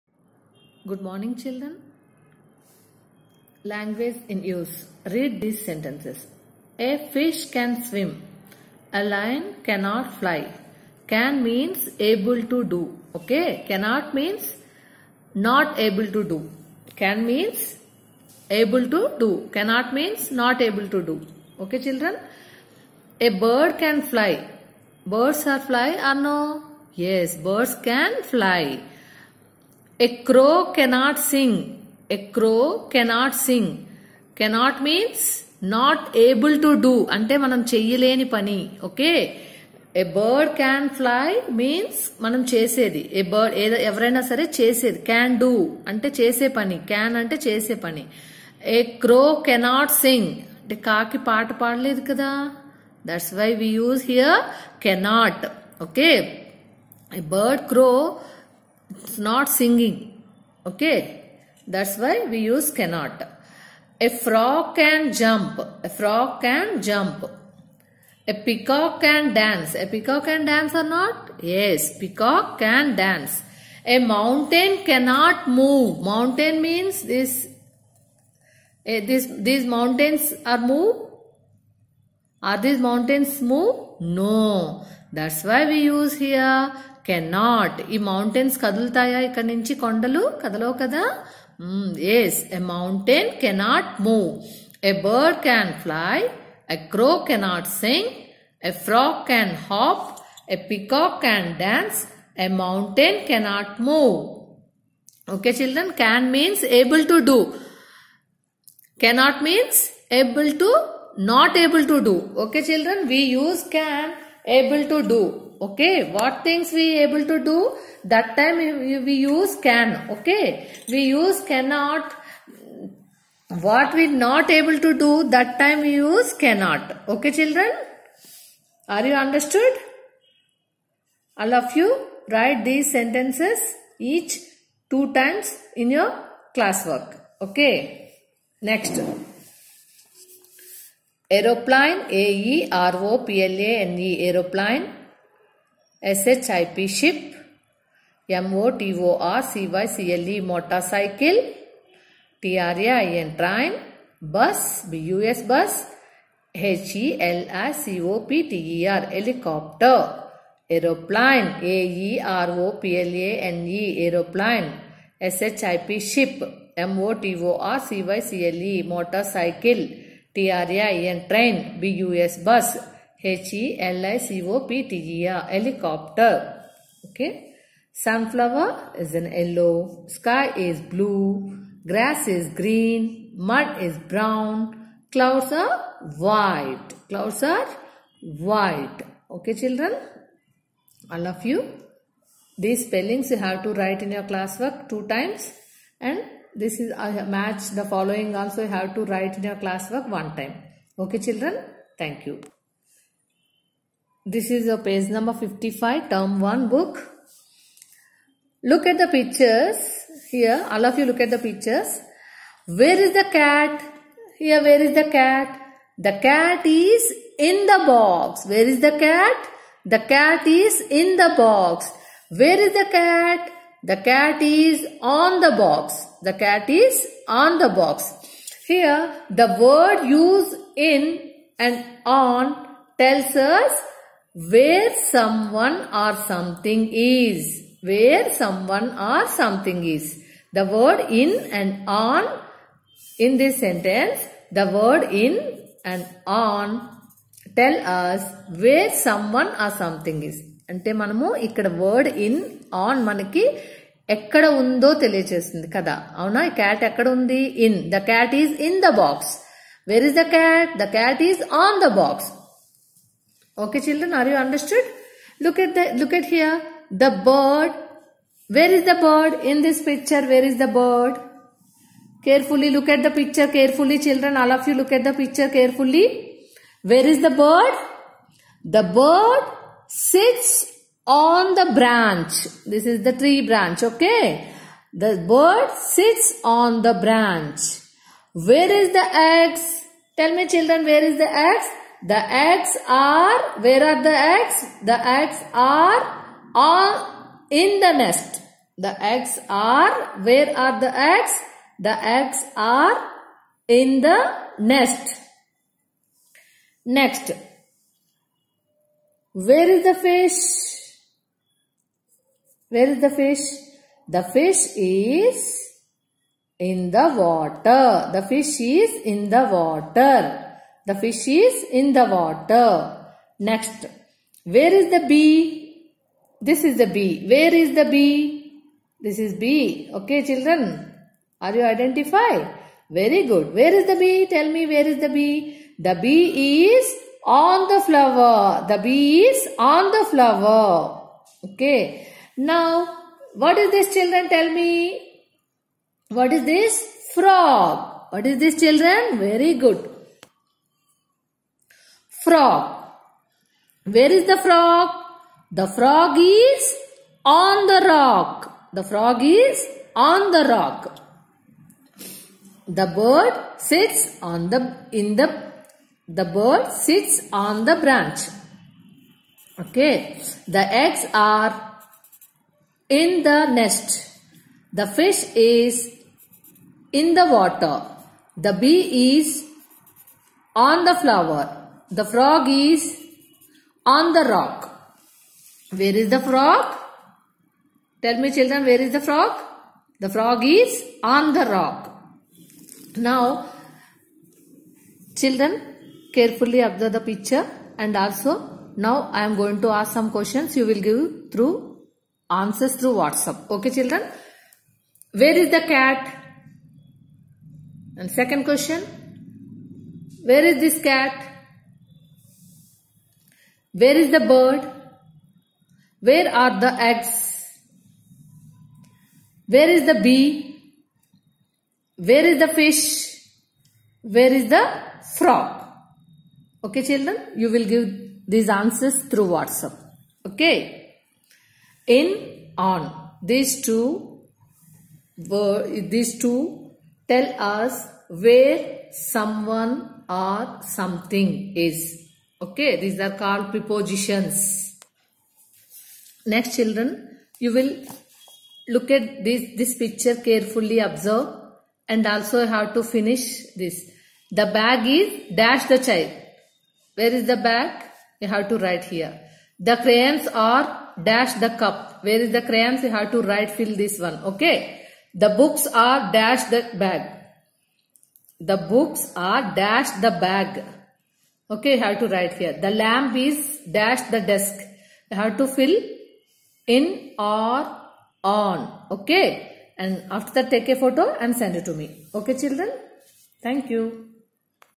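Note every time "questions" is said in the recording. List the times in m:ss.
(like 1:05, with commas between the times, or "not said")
6:40, 6:48.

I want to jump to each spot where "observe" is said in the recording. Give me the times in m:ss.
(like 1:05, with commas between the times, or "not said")
6:36, 7:30.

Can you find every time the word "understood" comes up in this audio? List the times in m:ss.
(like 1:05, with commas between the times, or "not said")
2:09, 4:24.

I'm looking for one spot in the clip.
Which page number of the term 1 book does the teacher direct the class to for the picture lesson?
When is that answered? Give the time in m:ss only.
3:24.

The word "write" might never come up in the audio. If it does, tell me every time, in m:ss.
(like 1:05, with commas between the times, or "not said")
2:12, 3:13, 3:19, 7:38, 7:43, 7:52.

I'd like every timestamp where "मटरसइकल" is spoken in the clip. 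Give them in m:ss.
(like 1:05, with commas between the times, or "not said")
2:30, 2:48.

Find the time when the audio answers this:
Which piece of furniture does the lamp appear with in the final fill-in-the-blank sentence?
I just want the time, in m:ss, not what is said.
7:54.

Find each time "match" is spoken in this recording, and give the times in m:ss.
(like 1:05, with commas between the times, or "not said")
3:17.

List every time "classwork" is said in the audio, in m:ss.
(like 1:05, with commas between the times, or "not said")
2:16, 3:14, 3:19.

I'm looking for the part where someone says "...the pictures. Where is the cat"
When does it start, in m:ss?
3:31.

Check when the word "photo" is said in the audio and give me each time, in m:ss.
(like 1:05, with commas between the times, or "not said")
8:00.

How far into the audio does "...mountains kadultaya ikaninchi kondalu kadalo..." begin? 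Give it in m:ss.
1:27.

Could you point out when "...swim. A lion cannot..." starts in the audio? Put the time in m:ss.
0:07.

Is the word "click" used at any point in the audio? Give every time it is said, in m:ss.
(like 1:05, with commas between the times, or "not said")
not said.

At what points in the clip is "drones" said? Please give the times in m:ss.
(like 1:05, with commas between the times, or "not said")
not said.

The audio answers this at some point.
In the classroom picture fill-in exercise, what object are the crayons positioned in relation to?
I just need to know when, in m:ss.
7:41.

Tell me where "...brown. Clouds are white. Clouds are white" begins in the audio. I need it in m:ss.
3:03.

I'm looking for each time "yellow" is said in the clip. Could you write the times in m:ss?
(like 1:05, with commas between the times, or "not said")
2:59.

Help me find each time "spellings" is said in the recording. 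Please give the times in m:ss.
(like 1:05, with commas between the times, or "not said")
3:12.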